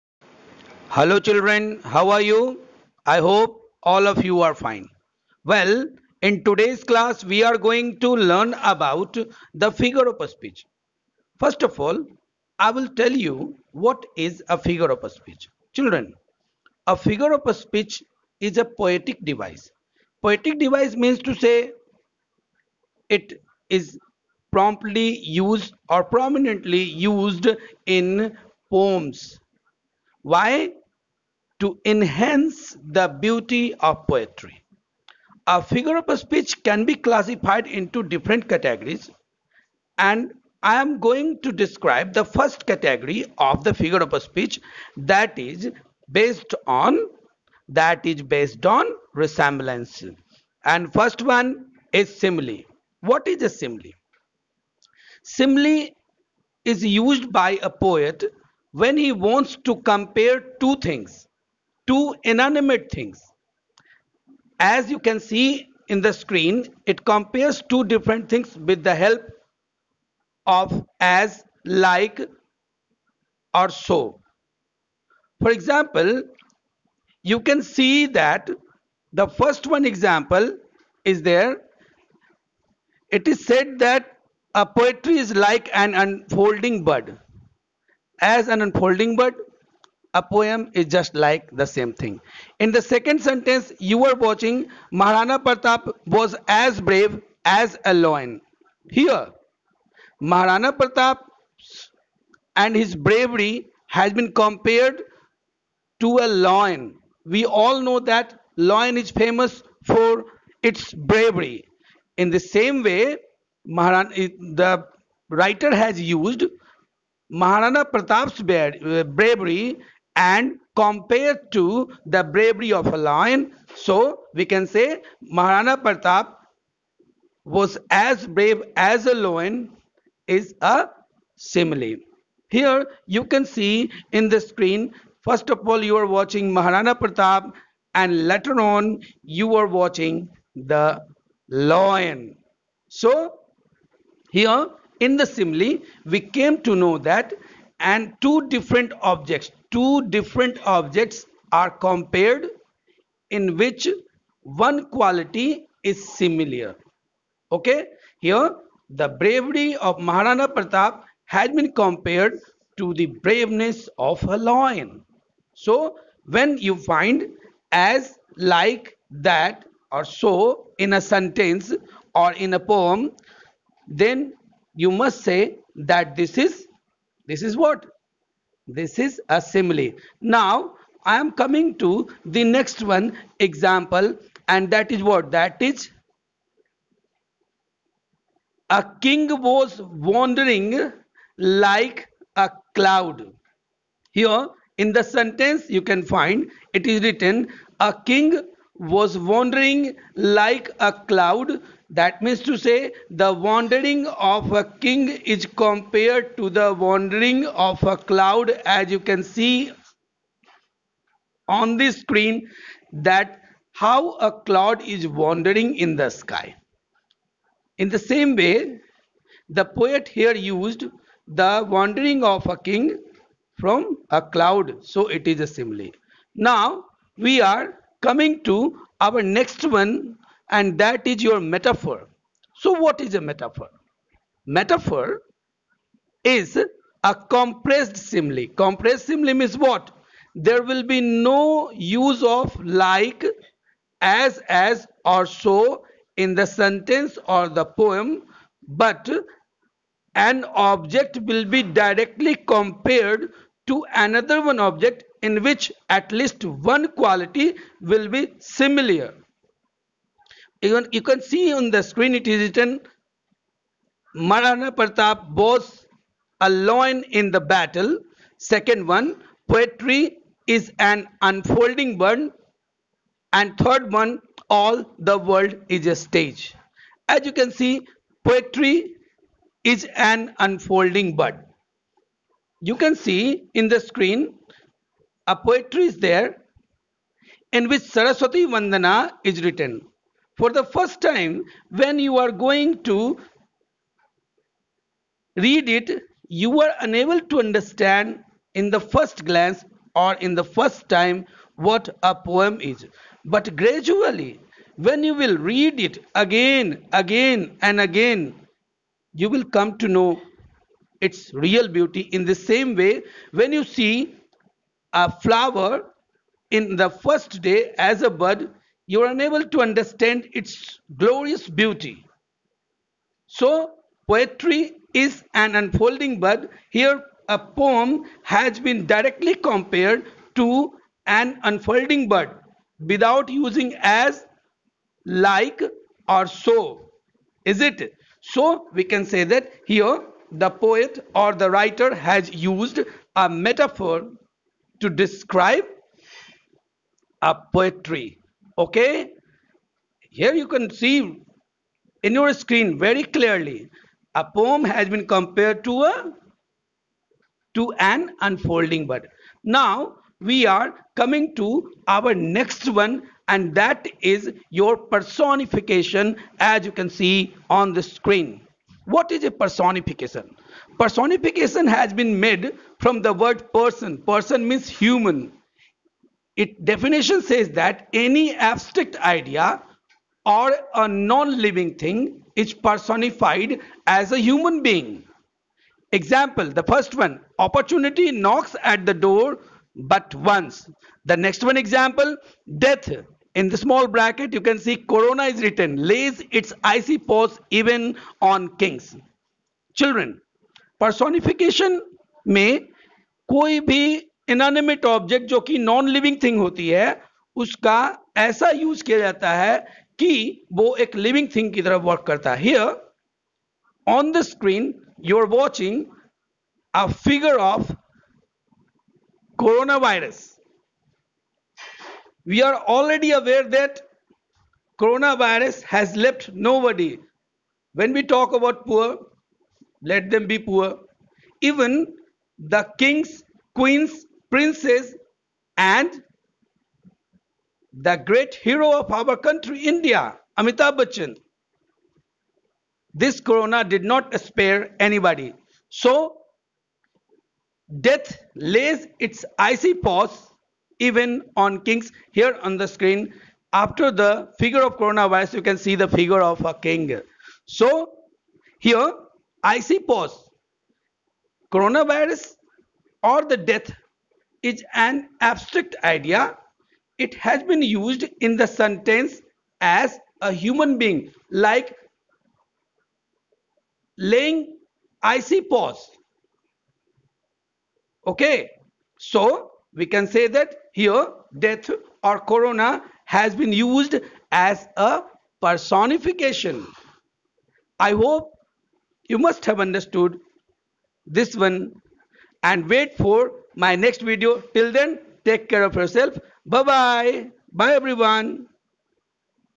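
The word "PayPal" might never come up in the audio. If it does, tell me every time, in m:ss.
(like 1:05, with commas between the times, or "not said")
not said.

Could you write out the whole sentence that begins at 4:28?
Second one, poetry is an unfolding one.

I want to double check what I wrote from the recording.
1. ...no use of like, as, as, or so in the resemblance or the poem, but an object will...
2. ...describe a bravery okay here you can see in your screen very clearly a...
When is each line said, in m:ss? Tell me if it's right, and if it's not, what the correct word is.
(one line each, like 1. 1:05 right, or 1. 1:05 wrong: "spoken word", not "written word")
1. 4:01 wrong: "sentence", not "resemblance"
2. 5:44 wrong: "poetry", not "bravery".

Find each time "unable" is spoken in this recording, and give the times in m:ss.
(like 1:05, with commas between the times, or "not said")
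4:56, 5:19.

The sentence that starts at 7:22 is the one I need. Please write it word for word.
This corona did not spare anybody.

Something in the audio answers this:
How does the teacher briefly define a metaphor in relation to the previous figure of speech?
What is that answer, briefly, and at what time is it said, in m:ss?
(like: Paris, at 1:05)
compressed simile, at 3:54.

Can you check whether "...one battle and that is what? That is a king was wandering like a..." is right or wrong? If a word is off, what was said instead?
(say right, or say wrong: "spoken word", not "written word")
wrong: "example", not "battle".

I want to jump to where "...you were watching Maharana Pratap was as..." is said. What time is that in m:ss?
1:33.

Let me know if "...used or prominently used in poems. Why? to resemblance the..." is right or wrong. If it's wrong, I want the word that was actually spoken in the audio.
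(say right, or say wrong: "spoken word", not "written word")
wrong: "enhance", not "resemblance".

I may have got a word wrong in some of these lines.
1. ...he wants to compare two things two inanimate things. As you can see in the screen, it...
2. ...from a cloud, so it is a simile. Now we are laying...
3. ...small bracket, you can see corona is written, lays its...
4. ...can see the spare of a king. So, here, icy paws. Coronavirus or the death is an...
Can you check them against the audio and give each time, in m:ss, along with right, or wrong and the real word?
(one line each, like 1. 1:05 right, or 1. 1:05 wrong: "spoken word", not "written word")
1. 0:58 right
2. 3:43 wrong: "coming", not "laying"
3. 6:33 right
4. 7:35 wrong: "figure", not "spare".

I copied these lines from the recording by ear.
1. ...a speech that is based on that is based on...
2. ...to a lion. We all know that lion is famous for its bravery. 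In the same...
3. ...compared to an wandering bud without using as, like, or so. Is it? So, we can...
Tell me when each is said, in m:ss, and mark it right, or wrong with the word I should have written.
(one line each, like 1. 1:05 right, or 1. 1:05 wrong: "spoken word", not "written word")
1. 0:44 right
2. 1:46 right
3. 5:29 wrong: "unfolding", not "wandering".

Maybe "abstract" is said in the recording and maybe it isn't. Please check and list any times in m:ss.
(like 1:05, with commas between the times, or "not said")
6:18, 7:45.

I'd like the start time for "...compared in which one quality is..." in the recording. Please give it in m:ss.
2:31.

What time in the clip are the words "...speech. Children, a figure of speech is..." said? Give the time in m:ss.
0:15.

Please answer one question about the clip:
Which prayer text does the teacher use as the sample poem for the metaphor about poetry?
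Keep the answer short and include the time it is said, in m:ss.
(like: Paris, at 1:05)
Saraswati Vandana, at 4:47.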